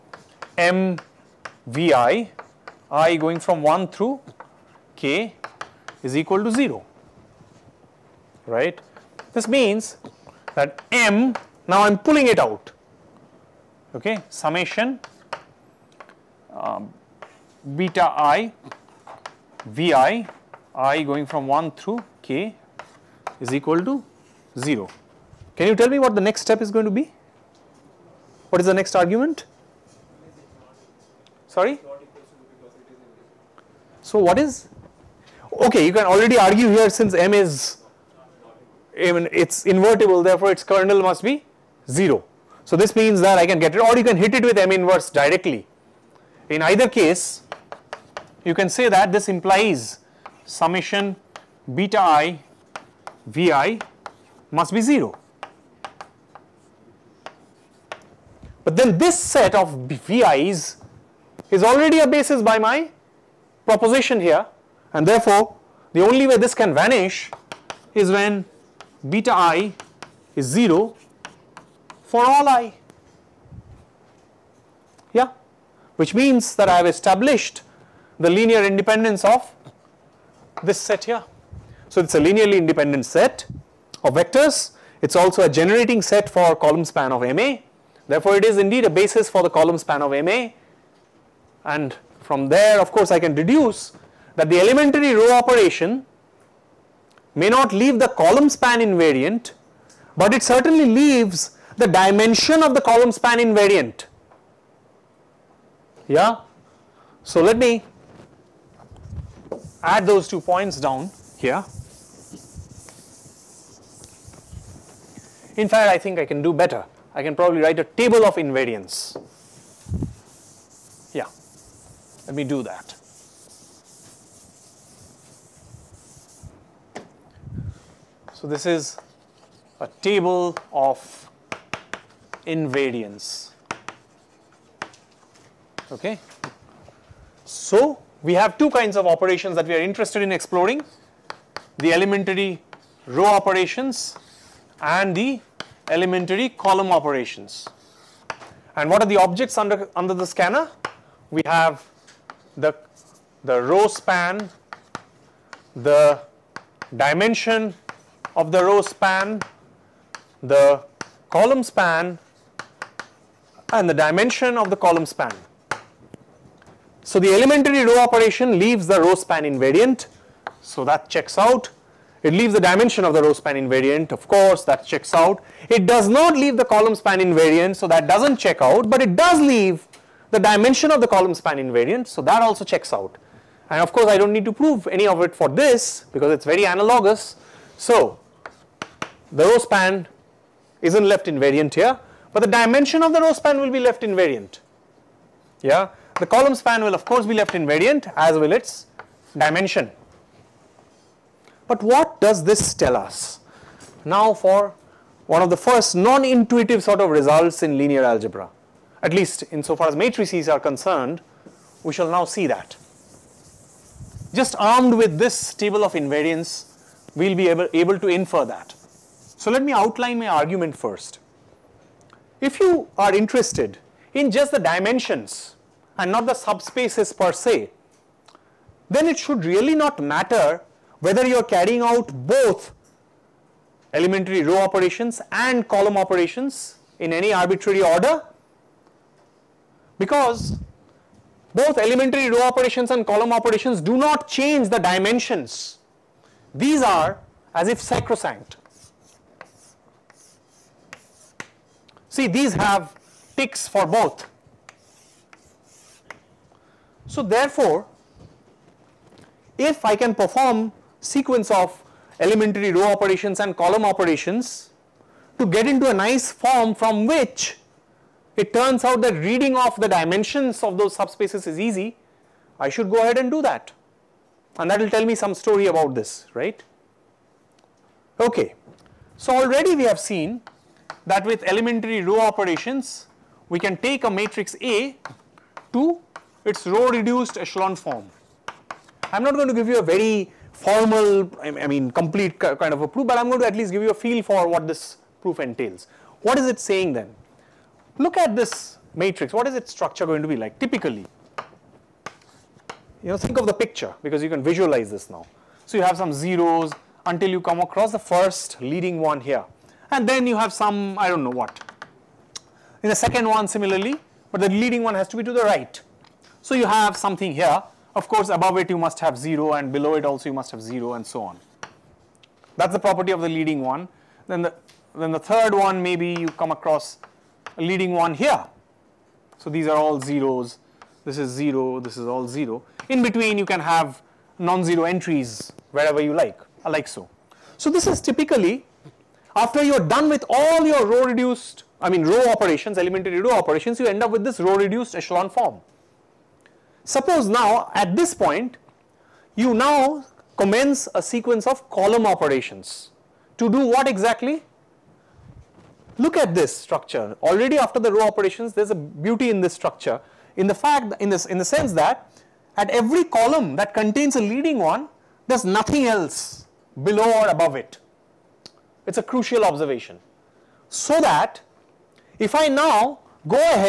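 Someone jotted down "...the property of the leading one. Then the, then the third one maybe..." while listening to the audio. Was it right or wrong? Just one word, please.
right.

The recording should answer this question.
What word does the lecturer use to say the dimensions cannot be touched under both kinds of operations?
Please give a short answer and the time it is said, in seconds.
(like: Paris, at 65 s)
Sacrosanct, at 247 s.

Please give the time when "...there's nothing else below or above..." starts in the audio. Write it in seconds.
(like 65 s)
365 s.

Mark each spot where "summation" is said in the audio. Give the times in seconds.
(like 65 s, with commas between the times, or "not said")
14 s, 50 s.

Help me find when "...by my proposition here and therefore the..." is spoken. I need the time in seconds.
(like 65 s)
62 s.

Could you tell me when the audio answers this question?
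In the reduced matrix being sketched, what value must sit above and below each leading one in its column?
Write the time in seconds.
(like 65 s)
318 s.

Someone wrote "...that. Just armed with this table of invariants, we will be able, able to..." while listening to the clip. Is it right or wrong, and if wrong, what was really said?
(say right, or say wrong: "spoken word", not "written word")
right.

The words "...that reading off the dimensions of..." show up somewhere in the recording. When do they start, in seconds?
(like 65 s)
269 s.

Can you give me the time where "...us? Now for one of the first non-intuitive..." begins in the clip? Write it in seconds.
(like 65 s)
202 s.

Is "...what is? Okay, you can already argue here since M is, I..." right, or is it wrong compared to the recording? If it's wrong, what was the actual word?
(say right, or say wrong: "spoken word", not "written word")
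right.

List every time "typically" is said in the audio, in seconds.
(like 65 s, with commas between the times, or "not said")
300 s, 338 s.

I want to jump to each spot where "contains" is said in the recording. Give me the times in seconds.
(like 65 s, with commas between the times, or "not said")
363 s.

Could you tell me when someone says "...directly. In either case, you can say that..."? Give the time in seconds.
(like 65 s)
45 s.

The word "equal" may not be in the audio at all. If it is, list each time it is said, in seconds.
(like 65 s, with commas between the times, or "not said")
6 s, 23 s.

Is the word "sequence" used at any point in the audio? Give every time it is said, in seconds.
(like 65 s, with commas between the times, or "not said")
260 s, 351 s.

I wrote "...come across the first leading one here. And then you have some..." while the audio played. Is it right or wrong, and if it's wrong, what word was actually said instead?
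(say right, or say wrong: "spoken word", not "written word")
right.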